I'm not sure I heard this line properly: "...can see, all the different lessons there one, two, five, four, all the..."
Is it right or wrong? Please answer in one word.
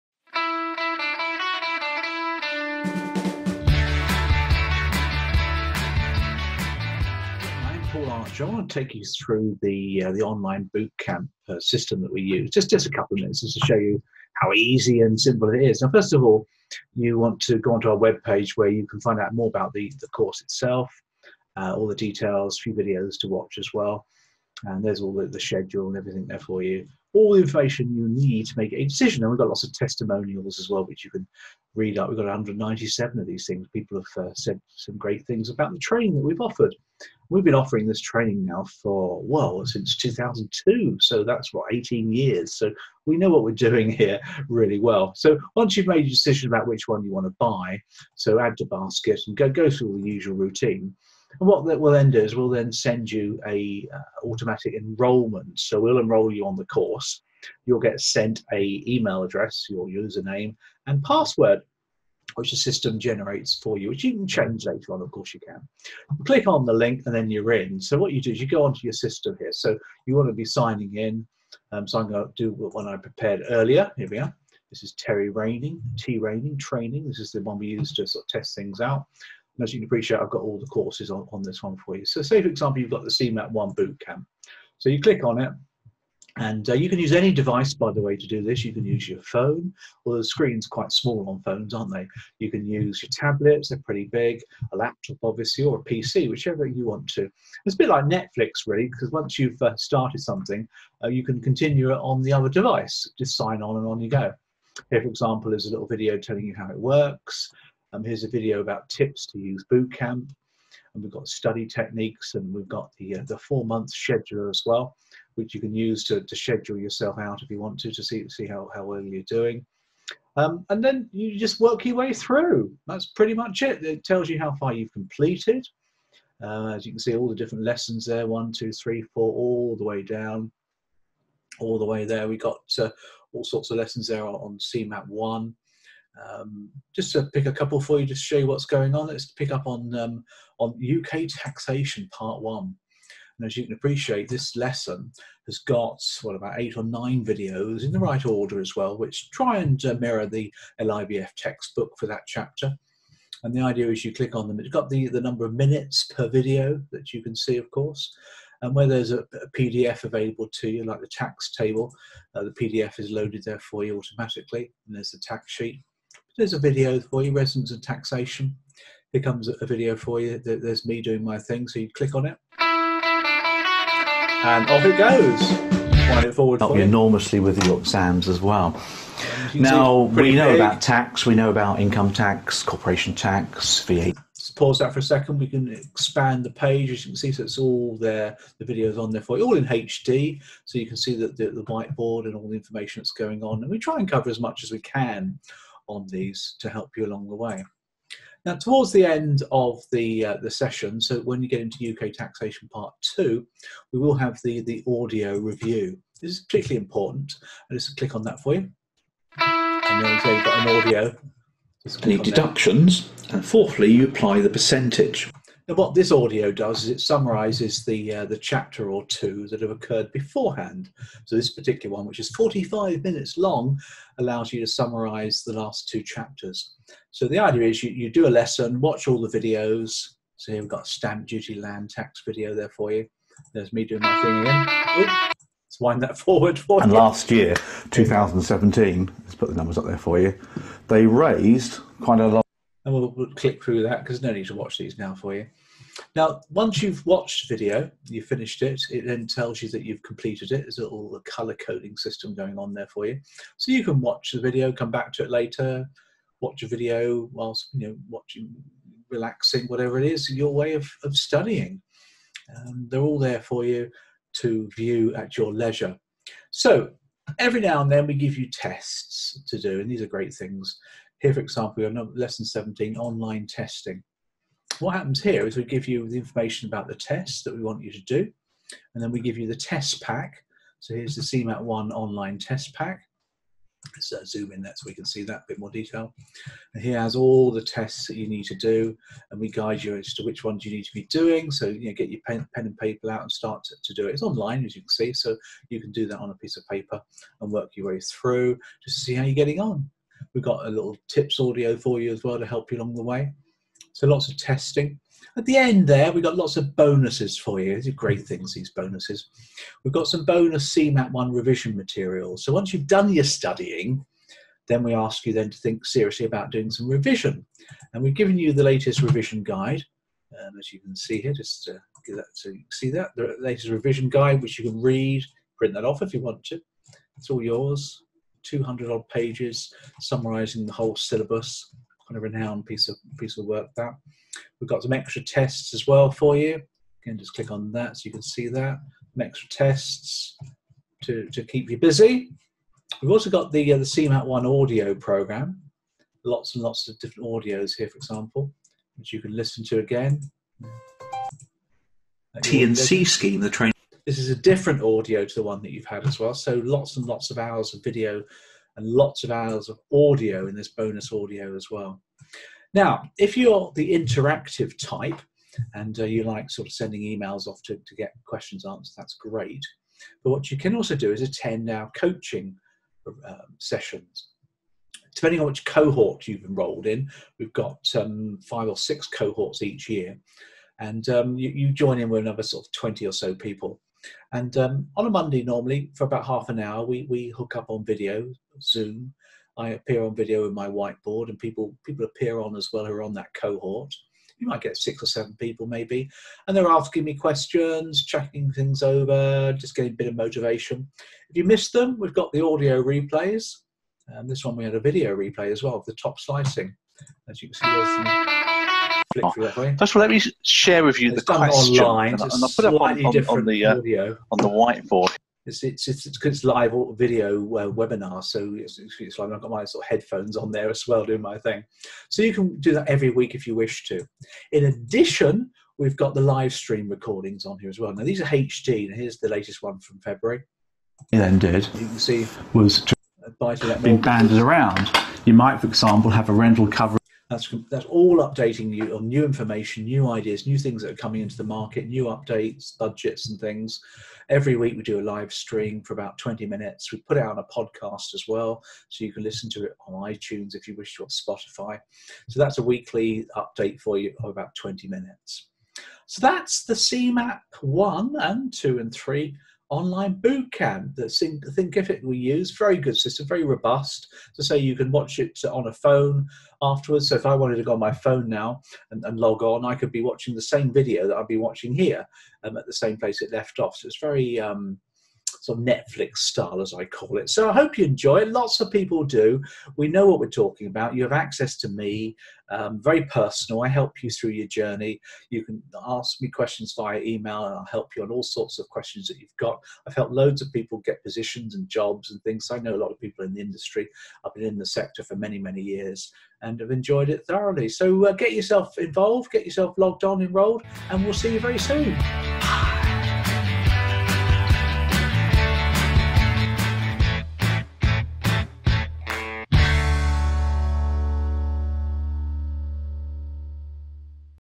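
wrong.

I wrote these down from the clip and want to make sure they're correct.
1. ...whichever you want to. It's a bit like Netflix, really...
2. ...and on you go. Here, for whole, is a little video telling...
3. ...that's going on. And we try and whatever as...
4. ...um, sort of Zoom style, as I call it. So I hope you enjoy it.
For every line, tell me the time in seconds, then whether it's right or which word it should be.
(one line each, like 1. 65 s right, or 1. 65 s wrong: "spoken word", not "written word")
1. 96 s right
2. 103 s wrong: "example", not "whole"
3. 192 s wrong: "cover", not "whatever"
4. 474 s wrong: "Netflix", not "Zoom".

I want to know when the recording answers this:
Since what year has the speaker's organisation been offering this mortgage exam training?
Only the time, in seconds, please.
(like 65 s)
39 s.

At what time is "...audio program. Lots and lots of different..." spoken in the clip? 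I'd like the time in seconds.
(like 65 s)
344 s.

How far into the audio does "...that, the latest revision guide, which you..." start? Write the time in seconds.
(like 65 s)
322 s.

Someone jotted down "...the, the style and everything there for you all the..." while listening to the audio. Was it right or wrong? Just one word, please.
wrong.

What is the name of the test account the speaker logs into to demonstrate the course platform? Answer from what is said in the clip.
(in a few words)
Terry Raining.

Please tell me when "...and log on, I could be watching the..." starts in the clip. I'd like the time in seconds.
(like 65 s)
469 s.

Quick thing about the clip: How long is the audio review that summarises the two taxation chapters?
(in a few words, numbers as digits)
45 minutes.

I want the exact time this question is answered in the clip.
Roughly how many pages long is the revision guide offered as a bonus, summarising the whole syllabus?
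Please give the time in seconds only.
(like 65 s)
328 s.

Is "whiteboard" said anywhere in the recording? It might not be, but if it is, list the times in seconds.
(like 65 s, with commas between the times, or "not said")
191 s, 390 s, 414 s.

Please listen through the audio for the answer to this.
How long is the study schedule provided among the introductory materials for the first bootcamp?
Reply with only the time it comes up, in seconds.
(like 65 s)
113 s.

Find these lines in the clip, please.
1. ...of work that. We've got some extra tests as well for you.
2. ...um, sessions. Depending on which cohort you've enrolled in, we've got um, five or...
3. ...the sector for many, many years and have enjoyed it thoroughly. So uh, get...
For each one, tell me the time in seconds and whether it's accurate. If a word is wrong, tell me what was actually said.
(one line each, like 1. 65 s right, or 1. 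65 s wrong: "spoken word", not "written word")
1. 333 s right
2. 373 s right
3. 494 s right.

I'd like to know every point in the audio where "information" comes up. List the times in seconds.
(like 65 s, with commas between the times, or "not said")
27 s, 192 s, 276 s, 439 s.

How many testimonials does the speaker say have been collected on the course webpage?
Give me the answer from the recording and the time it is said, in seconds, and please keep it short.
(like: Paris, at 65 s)
197, at 32 s.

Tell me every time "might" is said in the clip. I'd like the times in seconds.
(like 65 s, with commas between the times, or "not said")
394 s, 435 s.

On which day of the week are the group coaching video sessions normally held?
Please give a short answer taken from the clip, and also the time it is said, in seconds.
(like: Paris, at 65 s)
Monday, at 385 s.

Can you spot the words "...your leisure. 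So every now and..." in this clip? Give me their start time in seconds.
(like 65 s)
265 s.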